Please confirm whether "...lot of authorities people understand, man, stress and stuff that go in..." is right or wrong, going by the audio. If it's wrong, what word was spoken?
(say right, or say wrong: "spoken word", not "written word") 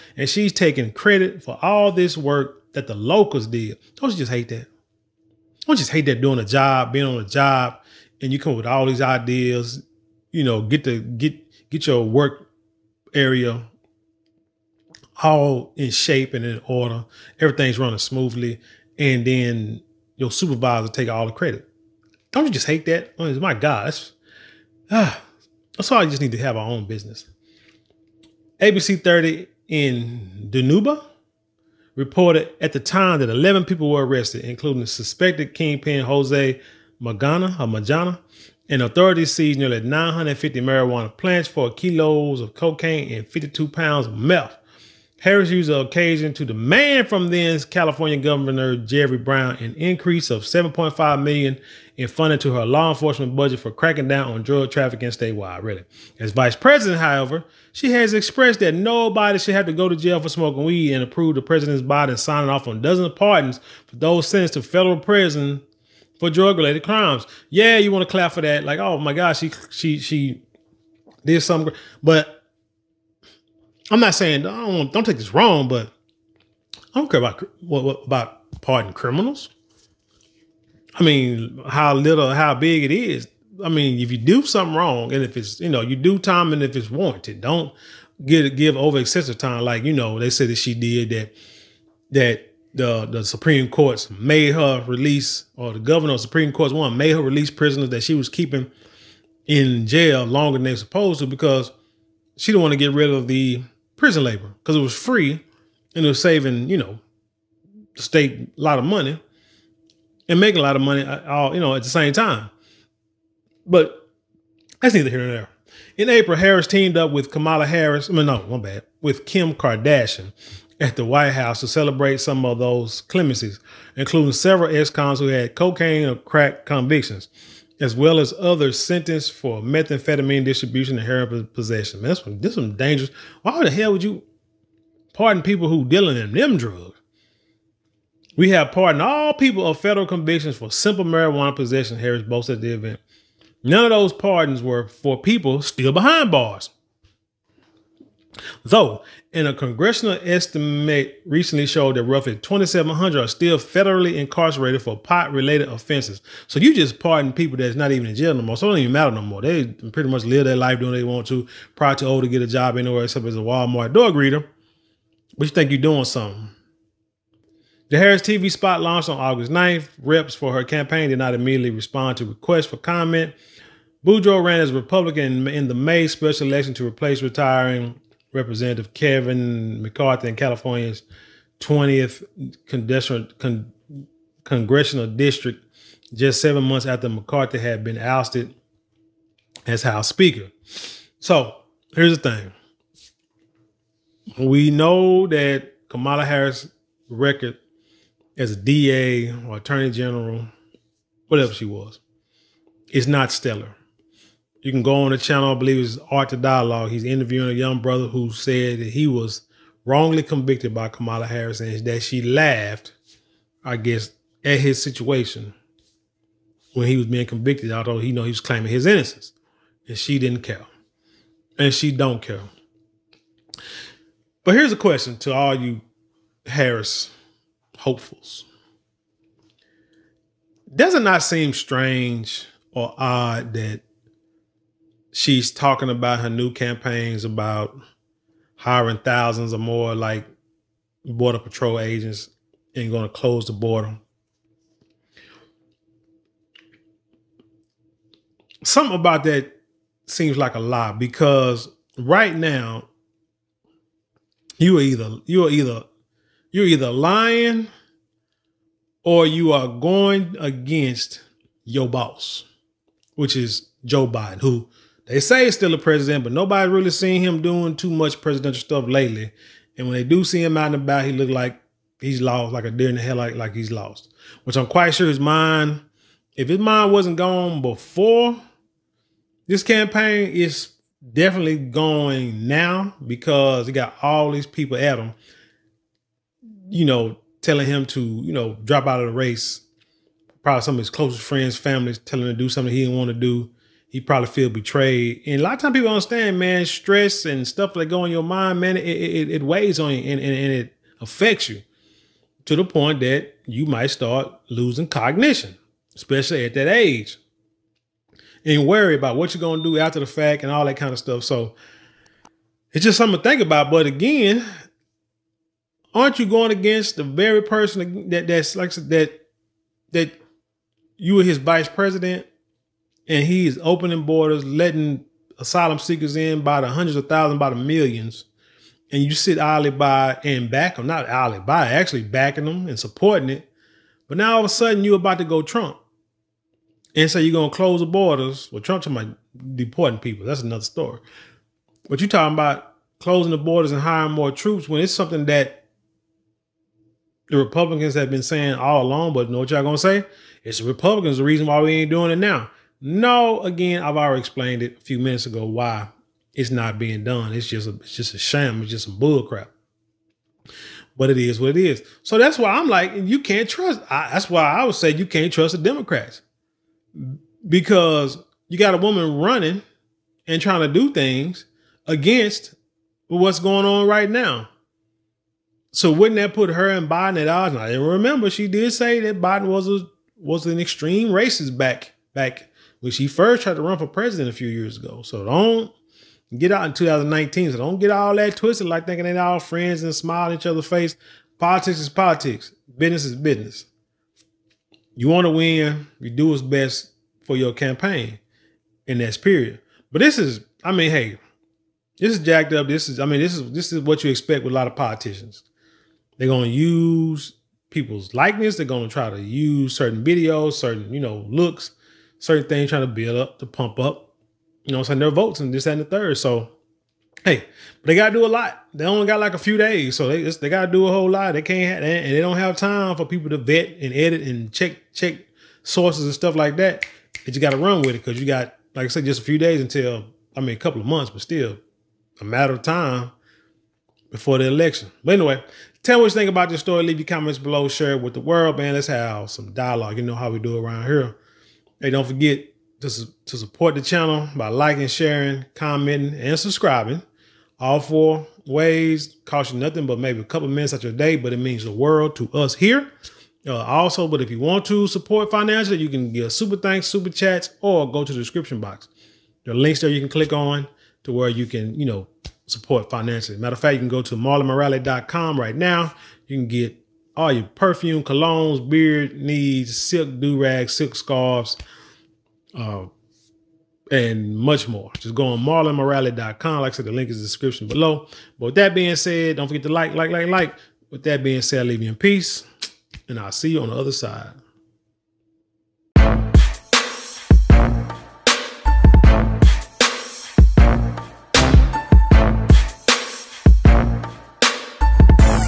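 wrong: "times", not "authorities".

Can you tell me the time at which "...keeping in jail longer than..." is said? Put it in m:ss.
1:38.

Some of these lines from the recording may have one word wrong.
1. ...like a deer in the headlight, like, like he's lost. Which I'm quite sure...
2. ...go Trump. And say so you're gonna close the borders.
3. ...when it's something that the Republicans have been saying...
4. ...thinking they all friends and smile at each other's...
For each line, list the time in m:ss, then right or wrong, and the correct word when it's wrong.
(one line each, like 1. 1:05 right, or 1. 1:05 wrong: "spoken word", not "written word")
1. 4:32 right
2. 5:35 right
3. 5:44 right
4. 6:28 right.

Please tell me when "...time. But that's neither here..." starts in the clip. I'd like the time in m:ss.
1:52.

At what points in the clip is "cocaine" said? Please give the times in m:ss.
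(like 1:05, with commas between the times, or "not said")
0:42, 2:05.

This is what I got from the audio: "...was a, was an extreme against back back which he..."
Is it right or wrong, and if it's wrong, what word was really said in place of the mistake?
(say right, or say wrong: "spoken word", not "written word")
wrong: "racist", not "against".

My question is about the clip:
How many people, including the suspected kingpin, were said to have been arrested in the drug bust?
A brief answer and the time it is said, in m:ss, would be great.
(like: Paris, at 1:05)
11, at 0:33.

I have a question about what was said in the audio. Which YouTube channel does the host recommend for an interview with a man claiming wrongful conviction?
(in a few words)
Art of Dialogue.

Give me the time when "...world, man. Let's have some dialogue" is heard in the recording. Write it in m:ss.
7:18.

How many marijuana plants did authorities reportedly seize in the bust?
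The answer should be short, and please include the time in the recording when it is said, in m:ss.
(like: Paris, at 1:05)
950, at 0:39.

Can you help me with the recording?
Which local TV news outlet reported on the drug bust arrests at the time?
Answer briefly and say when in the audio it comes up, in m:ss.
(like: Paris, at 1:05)
ABC 30, at 0:28.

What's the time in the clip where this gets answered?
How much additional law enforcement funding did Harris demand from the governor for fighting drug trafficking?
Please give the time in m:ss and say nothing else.
0:50.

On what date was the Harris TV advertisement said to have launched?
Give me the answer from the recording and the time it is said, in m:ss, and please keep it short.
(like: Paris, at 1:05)
August 9, at 2:49.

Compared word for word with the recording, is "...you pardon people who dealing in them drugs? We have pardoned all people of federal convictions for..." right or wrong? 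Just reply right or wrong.
right.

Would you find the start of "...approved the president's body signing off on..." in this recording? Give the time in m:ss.
1:01.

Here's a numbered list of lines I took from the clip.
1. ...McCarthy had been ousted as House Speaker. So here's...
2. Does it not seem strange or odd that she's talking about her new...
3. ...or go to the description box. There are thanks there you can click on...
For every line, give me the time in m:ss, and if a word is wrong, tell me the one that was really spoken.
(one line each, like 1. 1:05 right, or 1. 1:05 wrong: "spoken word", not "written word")
1. 3:07 right
2. 3:50 right
3. 7:37 wrong: "links", not "thanks".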